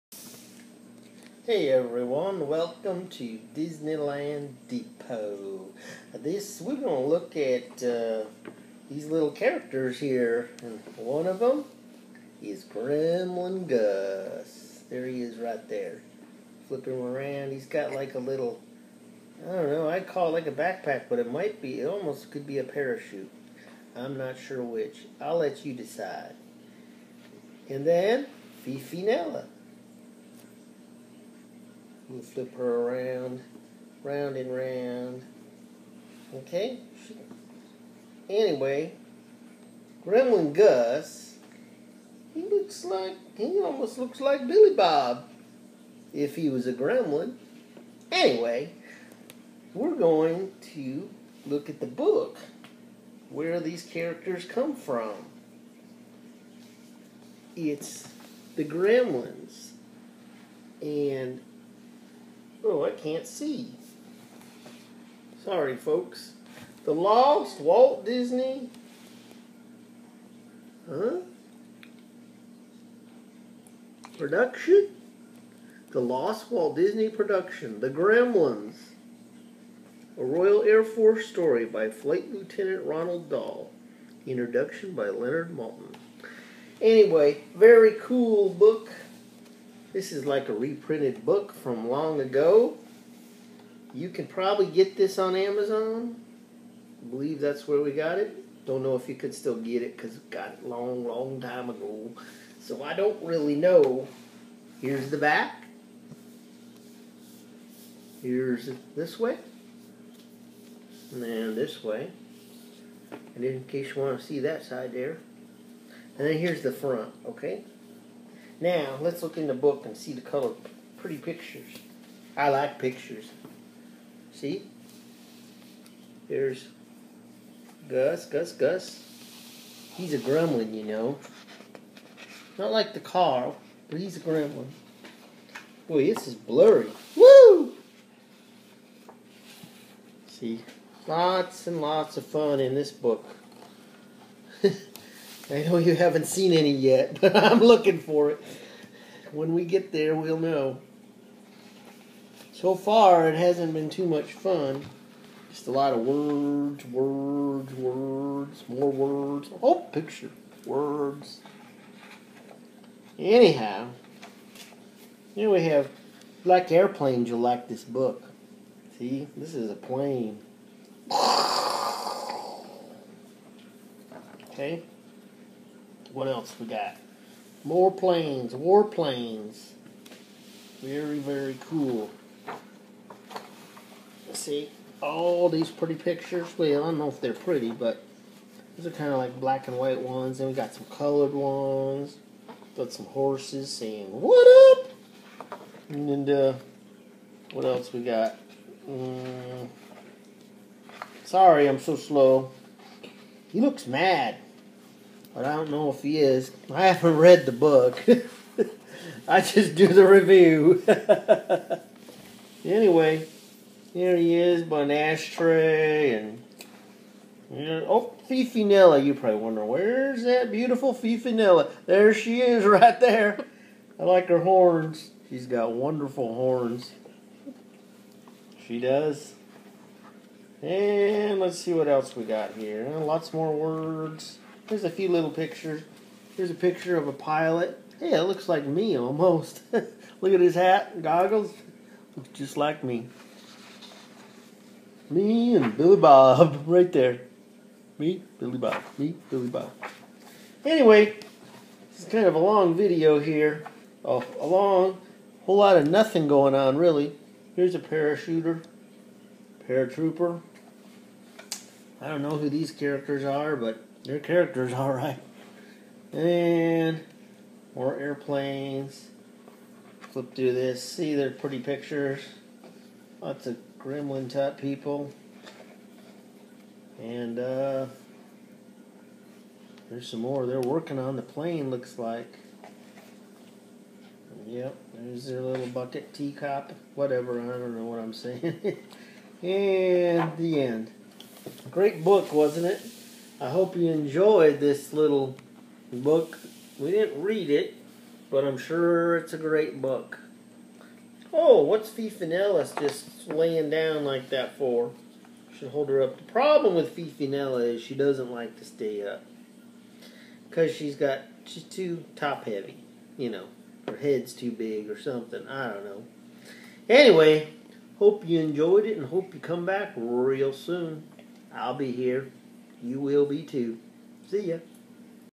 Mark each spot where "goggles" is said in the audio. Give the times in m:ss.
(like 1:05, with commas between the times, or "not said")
4:01.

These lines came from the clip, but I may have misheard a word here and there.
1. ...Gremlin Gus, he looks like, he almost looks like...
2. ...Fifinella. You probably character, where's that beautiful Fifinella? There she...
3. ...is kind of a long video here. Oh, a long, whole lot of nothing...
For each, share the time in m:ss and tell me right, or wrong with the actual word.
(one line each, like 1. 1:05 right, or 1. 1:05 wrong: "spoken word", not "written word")
1. 0:40 right
2. 3:38 wrong: "wonder", not "character"
3. 4:12 right.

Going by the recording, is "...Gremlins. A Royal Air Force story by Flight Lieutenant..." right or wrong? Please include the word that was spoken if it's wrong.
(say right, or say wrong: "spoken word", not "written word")
right.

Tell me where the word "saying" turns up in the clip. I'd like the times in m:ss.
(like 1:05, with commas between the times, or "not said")
3:13, 4:48.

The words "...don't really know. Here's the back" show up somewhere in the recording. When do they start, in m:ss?
1:42.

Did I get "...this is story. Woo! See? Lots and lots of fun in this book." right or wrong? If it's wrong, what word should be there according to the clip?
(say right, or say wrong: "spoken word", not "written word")
wrong: "blurry", not "story".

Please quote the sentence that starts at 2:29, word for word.
When we get there, we'll know.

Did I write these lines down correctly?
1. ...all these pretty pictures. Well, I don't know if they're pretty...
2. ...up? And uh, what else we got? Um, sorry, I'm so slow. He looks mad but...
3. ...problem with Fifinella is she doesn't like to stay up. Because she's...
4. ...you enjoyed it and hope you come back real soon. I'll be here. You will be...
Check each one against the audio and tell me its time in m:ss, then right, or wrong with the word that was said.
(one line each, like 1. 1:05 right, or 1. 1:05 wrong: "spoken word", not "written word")
1. 3:05 right
2. 3:14 right
3. 5:06 right
4. 5:18 right.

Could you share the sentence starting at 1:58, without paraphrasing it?
Now, let's look in the book and see the color.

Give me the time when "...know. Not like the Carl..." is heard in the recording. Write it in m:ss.
2:10.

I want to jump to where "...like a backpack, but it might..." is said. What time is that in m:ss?
0:20.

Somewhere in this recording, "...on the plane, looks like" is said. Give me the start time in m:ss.
4:40.